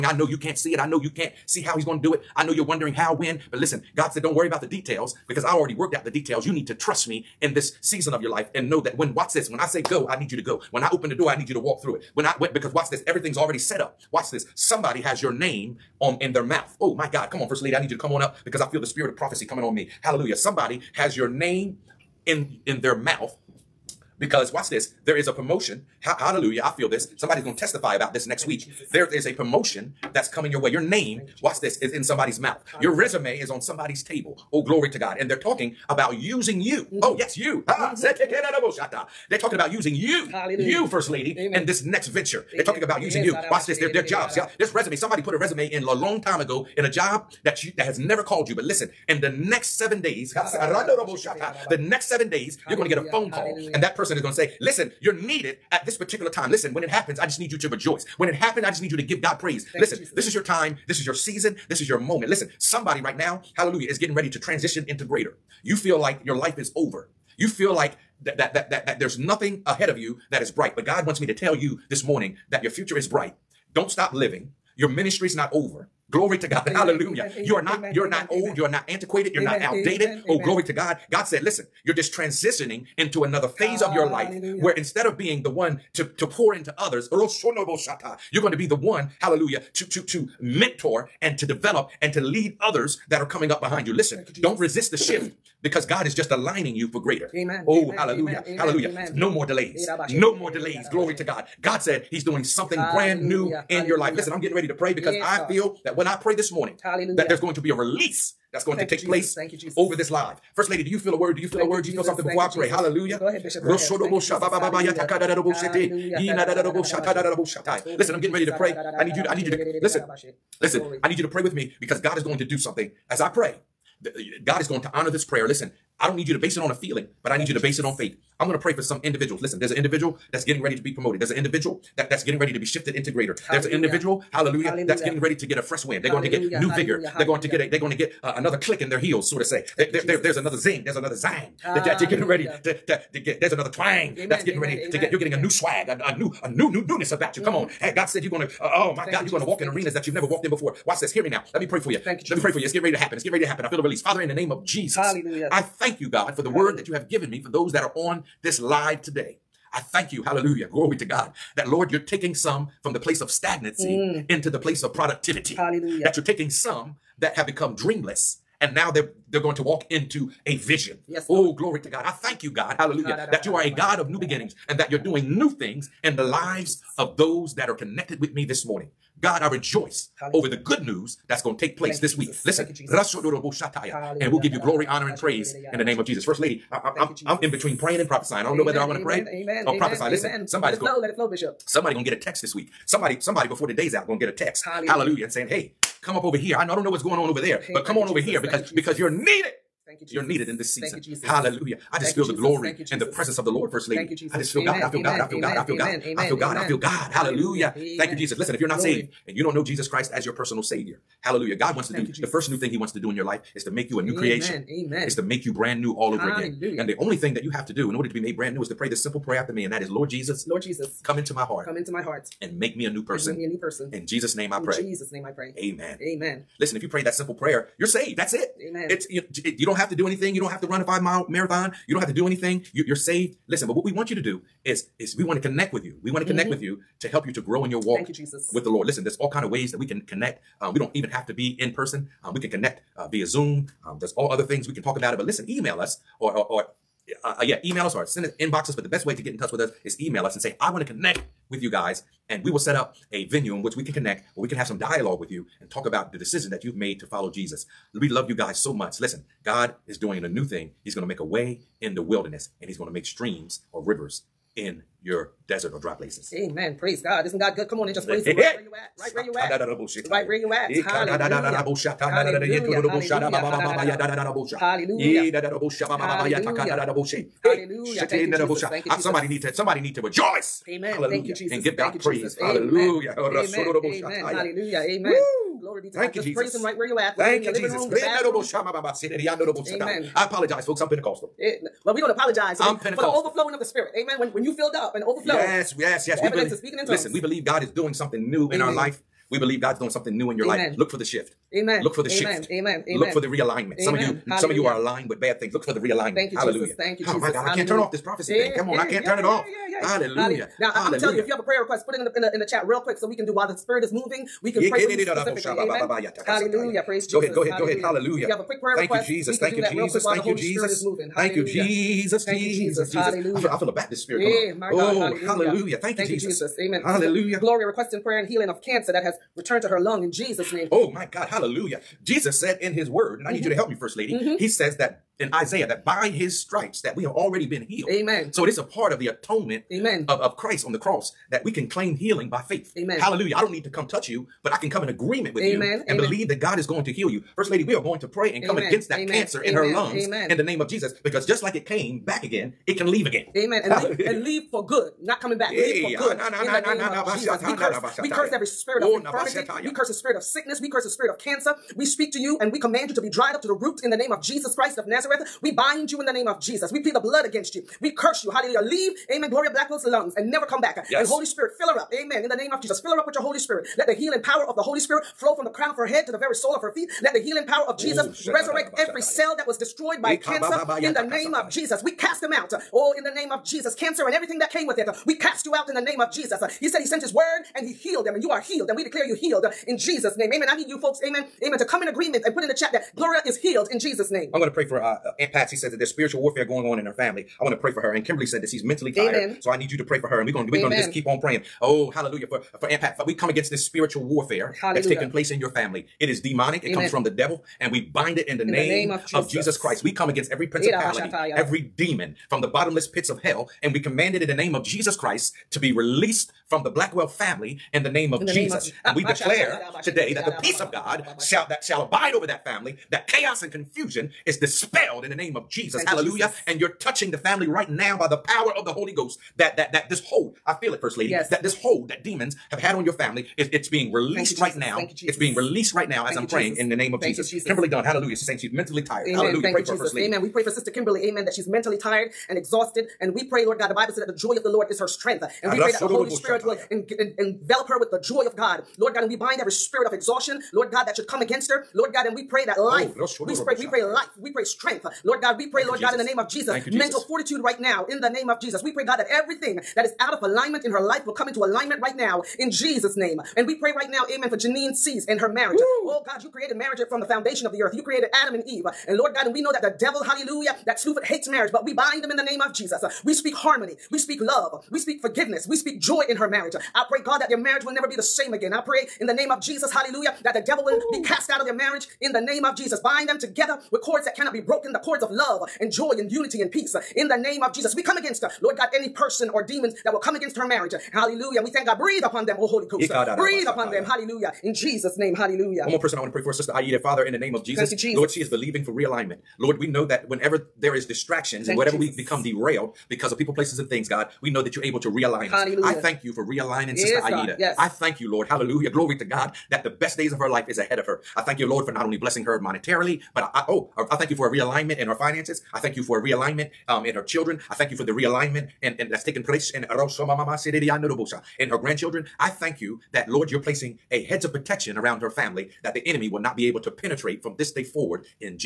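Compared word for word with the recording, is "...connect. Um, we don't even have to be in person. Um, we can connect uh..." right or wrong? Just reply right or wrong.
right.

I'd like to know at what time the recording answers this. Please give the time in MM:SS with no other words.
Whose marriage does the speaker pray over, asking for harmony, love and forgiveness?
07:44.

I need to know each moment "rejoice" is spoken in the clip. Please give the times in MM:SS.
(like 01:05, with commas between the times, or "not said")
00:57, 02:59, 04:40.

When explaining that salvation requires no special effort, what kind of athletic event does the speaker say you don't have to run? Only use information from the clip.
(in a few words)
five mile marathon.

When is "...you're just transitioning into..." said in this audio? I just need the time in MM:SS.
01:21.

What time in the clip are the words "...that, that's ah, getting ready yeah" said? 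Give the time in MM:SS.
02:21.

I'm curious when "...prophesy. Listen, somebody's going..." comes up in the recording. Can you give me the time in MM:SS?
03:09.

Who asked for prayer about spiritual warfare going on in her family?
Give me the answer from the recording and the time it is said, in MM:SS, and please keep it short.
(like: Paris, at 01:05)
Aunt Patsy, at 06:35.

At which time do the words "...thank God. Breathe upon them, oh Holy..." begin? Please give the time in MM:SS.
08:11.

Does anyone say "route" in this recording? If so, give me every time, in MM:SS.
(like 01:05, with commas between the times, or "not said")
not said.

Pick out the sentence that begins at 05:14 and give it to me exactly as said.
We can yeah, pray for you specifically.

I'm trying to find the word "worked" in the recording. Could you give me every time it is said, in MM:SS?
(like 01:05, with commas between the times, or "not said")
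00:05.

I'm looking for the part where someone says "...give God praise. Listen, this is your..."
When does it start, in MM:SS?
00:59.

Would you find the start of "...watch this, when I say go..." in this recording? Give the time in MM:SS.
00:09.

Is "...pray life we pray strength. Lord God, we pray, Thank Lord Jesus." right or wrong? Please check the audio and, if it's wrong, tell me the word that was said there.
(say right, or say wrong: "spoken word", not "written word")
right.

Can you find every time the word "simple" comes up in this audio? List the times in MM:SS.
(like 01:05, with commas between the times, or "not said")
03:39, 03:47.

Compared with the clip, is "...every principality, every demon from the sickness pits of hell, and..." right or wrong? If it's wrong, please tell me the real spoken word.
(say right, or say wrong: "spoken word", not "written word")
wrong: "bottomless", not "sickness".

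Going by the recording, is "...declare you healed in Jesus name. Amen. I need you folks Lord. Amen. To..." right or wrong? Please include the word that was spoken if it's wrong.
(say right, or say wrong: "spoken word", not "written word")
wrong: "Amen", not "Lord".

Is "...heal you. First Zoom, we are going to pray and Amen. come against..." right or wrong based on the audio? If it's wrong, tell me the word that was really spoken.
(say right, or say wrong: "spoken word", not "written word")
wrong: "Lady", not "Zoom".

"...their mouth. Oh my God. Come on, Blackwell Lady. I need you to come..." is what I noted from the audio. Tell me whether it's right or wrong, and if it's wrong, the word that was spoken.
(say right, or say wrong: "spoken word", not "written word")
wrong: "First", not "Blackwell".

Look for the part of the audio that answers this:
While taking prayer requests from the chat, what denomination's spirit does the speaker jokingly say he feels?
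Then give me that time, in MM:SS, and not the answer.
05:23.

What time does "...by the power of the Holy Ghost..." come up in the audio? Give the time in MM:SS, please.
07:07.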